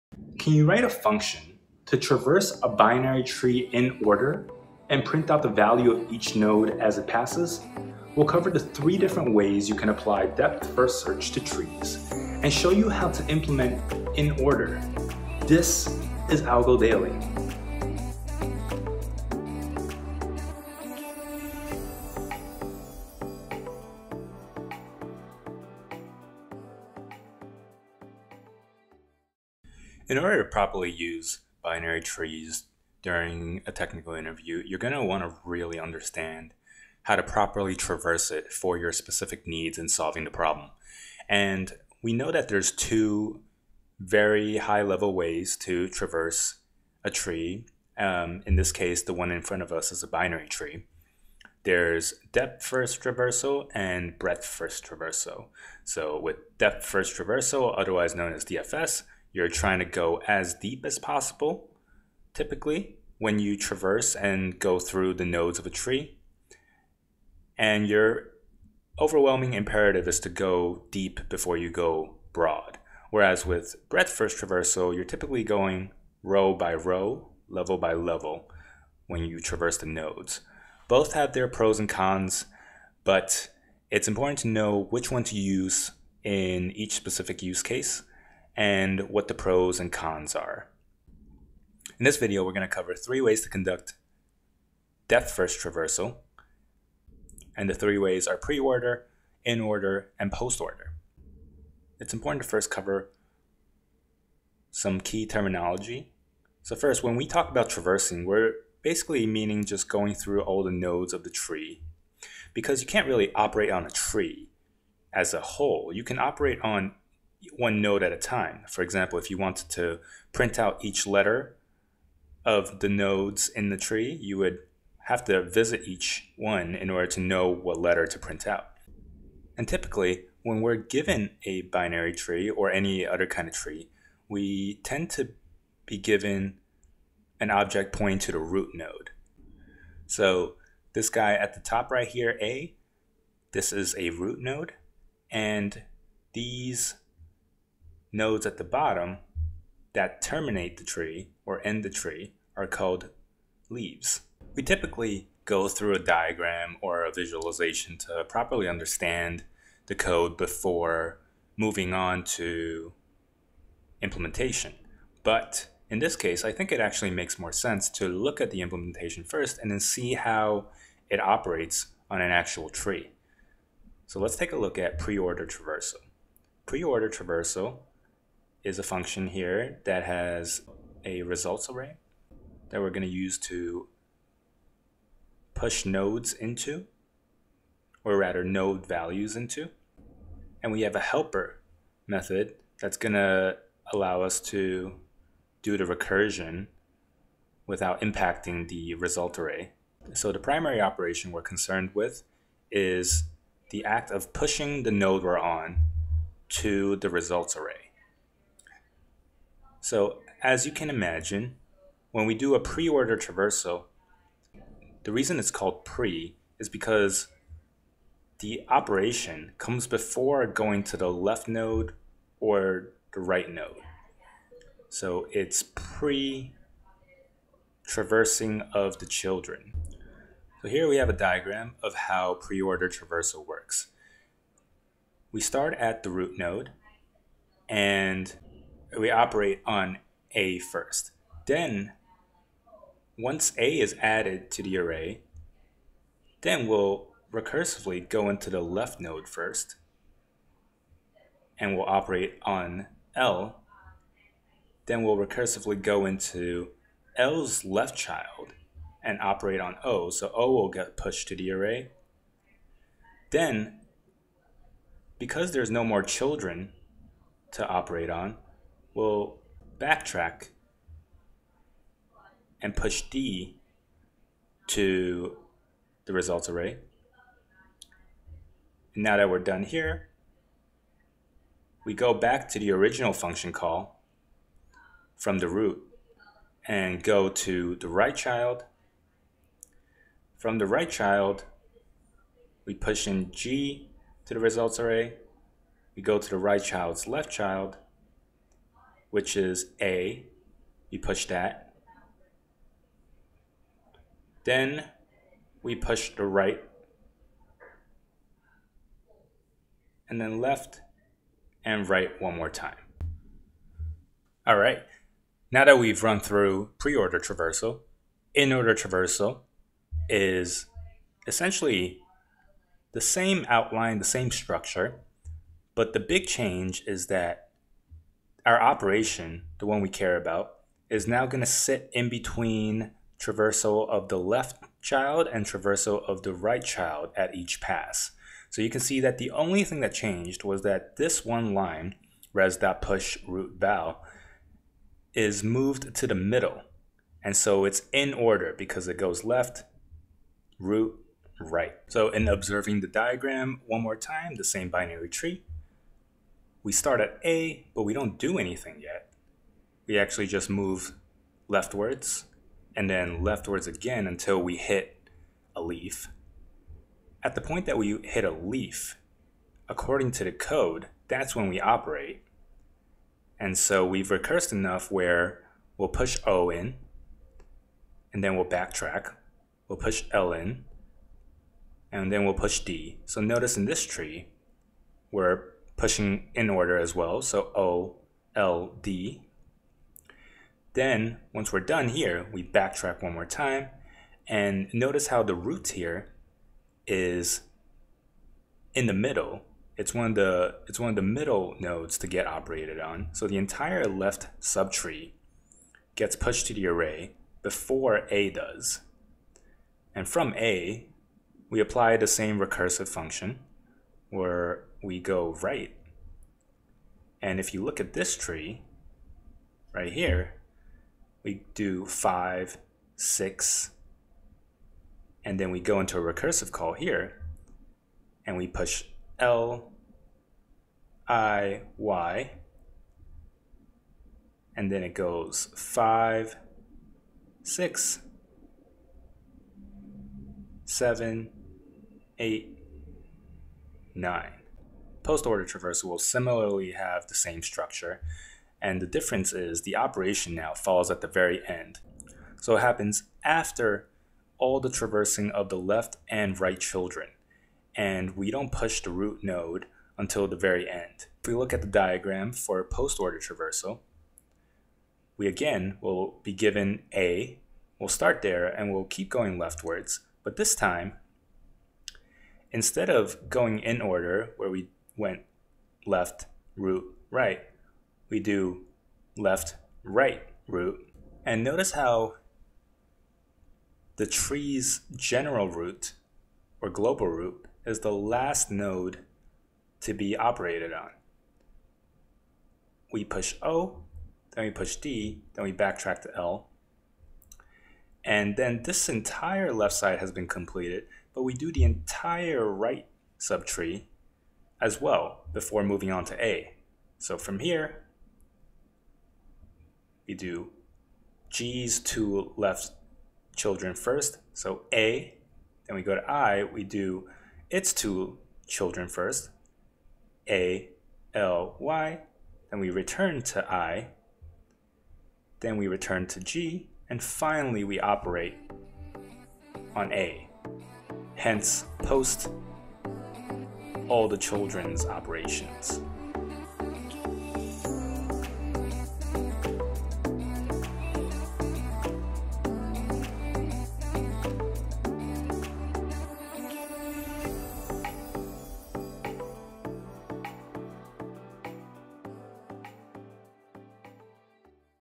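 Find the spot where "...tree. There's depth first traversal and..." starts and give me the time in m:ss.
0:50.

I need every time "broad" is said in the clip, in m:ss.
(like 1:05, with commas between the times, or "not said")
1:12.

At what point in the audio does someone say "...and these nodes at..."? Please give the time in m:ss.
2:25.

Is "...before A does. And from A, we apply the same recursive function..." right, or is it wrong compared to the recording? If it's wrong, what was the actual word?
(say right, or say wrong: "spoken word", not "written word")
right.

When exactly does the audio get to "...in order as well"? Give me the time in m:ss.
6:26.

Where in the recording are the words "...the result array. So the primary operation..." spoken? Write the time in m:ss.
3:18.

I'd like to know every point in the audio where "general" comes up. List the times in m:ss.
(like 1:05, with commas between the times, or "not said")
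8:04.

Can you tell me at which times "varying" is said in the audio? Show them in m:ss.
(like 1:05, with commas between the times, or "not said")
not said.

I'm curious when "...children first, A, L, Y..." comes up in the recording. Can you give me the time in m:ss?
8:38.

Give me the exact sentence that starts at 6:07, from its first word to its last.
At the point that we hit a leaf, according to the code, that's when we operate.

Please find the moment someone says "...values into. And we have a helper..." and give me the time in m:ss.
3:08.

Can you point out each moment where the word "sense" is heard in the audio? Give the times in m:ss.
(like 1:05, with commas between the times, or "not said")
2:47.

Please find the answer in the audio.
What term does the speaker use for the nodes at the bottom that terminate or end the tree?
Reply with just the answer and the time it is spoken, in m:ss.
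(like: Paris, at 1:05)
leaves, at 2:33.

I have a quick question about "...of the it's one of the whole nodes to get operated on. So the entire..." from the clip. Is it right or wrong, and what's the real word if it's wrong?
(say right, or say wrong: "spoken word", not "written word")
wrong: "middle", not "whole".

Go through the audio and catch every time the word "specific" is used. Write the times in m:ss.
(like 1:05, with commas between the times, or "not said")
0:38, 1:26.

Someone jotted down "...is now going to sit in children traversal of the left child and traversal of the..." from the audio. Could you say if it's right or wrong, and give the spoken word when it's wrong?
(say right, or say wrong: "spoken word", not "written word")
wrong: "between", not "children".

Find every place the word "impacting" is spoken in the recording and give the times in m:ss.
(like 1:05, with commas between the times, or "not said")
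3:18.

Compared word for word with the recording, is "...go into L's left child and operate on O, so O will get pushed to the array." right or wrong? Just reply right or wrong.
right.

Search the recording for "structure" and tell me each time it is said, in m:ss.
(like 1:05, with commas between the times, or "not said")
5:24, 7:27.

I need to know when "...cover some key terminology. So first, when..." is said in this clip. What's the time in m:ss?
1:42.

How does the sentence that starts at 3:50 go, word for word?
So here we have a diagram of how pre-order traversal works.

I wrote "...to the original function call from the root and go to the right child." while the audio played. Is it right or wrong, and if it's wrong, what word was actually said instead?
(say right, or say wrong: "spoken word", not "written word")
right.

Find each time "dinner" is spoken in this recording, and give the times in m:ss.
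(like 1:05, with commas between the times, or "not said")
not said.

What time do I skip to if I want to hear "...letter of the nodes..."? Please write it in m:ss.
2:01.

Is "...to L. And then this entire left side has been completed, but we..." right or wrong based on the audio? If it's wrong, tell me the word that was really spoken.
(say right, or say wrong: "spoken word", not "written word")
right.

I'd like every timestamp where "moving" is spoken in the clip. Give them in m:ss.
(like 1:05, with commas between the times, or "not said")
2:41, 8:25.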